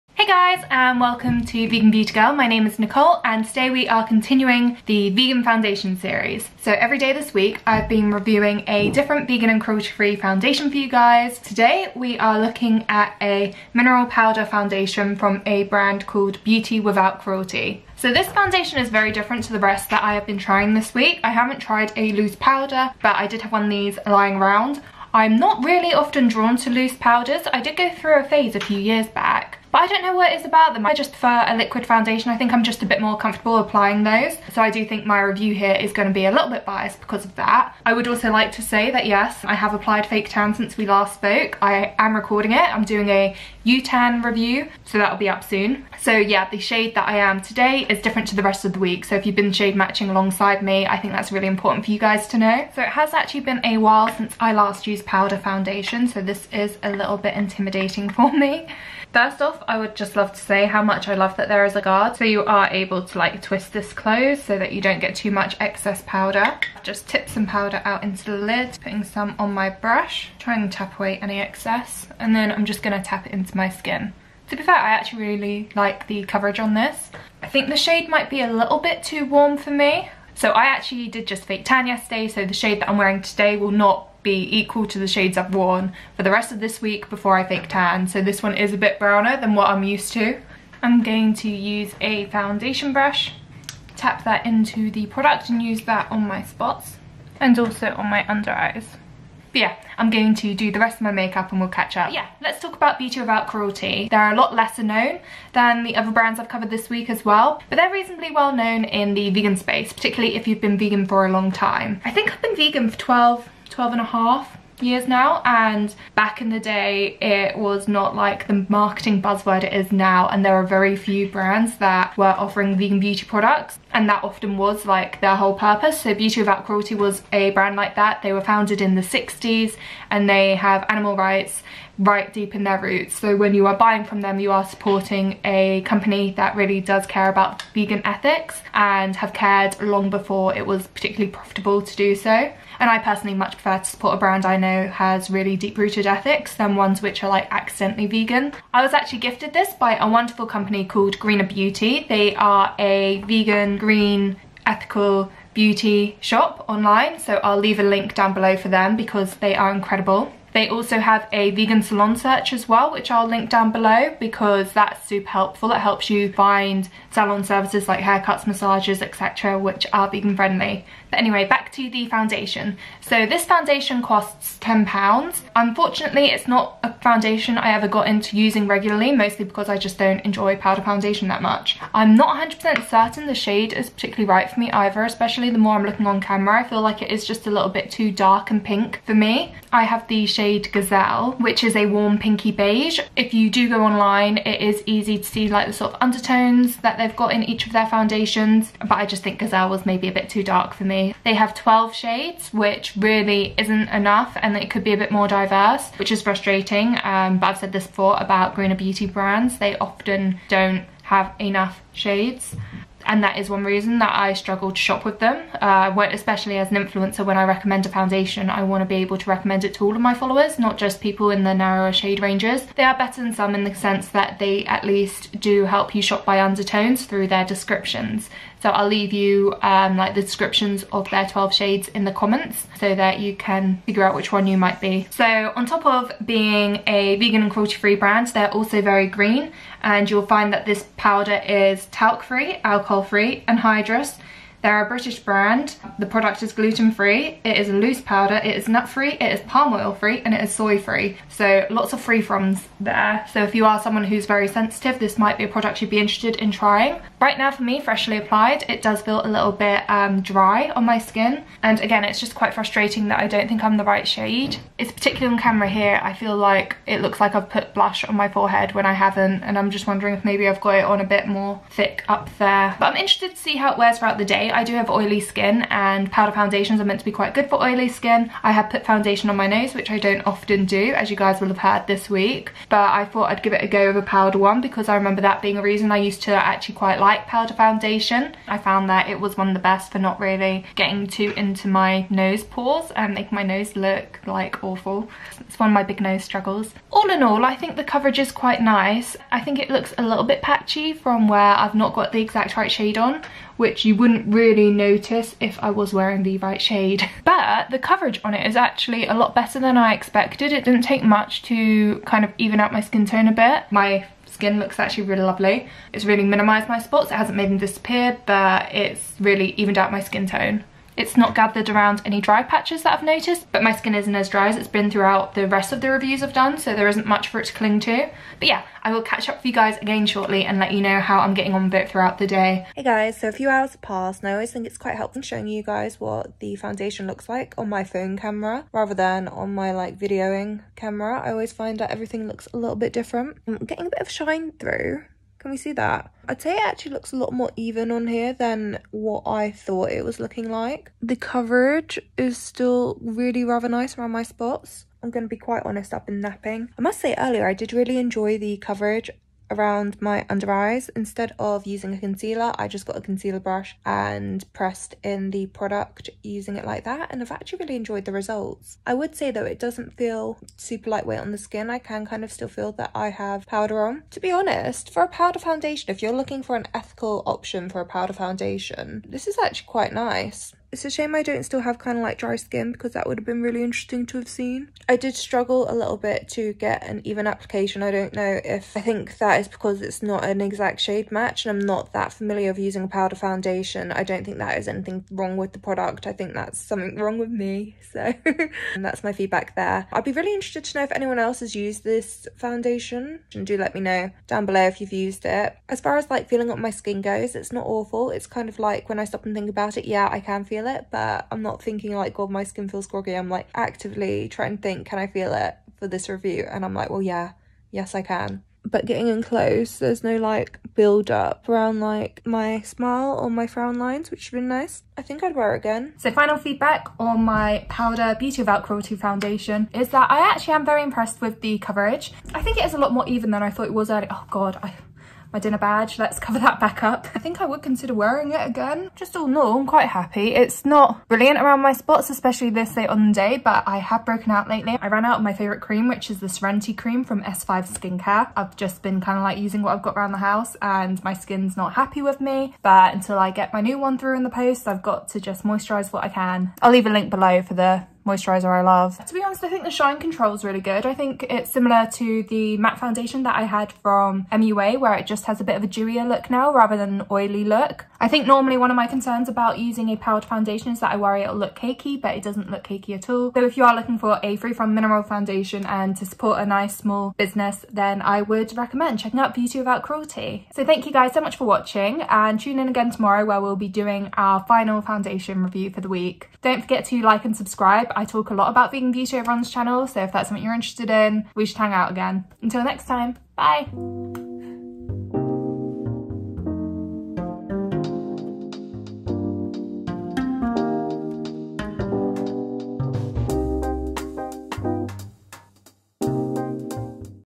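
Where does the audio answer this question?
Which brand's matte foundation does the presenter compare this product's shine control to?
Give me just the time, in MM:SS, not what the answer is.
07:44.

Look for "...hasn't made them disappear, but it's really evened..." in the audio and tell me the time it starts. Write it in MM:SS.
05:17.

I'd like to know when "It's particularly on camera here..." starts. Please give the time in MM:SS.
04:24.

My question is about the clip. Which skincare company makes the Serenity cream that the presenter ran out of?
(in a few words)
S5 Skincare.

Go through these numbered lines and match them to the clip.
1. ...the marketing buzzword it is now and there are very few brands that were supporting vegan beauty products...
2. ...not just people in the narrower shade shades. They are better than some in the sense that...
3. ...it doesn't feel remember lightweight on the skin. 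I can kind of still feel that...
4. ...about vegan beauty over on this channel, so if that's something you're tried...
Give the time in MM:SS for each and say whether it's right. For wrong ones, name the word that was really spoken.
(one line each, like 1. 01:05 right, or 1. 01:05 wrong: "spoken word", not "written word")
1. 01:58 wrong: "offering", not "supporting"
2. 03:40 wrong: "ranges", not "shades"
3. 06:09 wrong: "super", not "remember"
4. 08:08 wrong: "interested", not "tried".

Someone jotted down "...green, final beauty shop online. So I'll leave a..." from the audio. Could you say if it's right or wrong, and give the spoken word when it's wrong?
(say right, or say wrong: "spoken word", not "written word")
wrong: "ethical", not "final".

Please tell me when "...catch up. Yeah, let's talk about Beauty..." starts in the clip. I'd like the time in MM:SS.
01:41.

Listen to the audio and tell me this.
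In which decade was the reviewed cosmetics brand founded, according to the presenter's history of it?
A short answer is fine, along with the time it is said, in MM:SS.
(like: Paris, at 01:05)
the 60s, at 02:08.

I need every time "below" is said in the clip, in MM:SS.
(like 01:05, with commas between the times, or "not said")
02:38, 02:43, 06:44, 07:37.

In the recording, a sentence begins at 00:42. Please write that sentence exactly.
I'm doing a UTAN review, so that'll be up soon.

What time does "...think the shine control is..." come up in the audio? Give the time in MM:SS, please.
07:39.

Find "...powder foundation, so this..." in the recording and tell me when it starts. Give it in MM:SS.
00:55.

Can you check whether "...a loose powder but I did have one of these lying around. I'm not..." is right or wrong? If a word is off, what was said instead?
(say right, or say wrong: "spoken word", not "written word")
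right.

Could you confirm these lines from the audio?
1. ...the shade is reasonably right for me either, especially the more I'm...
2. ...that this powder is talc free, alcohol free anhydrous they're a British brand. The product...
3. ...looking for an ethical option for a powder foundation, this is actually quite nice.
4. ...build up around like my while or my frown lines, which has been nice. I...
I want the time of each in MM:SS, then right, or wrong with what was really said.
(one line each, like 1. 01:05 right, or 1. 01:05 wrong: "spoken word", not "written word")
1. 03:03 wrong: "particularly", not "reasonably"
2. 04:00 right
3. 06:16 right
4. 07:00 wrong: "smile", not "while".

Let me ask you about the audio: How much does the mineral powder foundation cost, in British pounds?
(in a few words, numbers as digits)
£10.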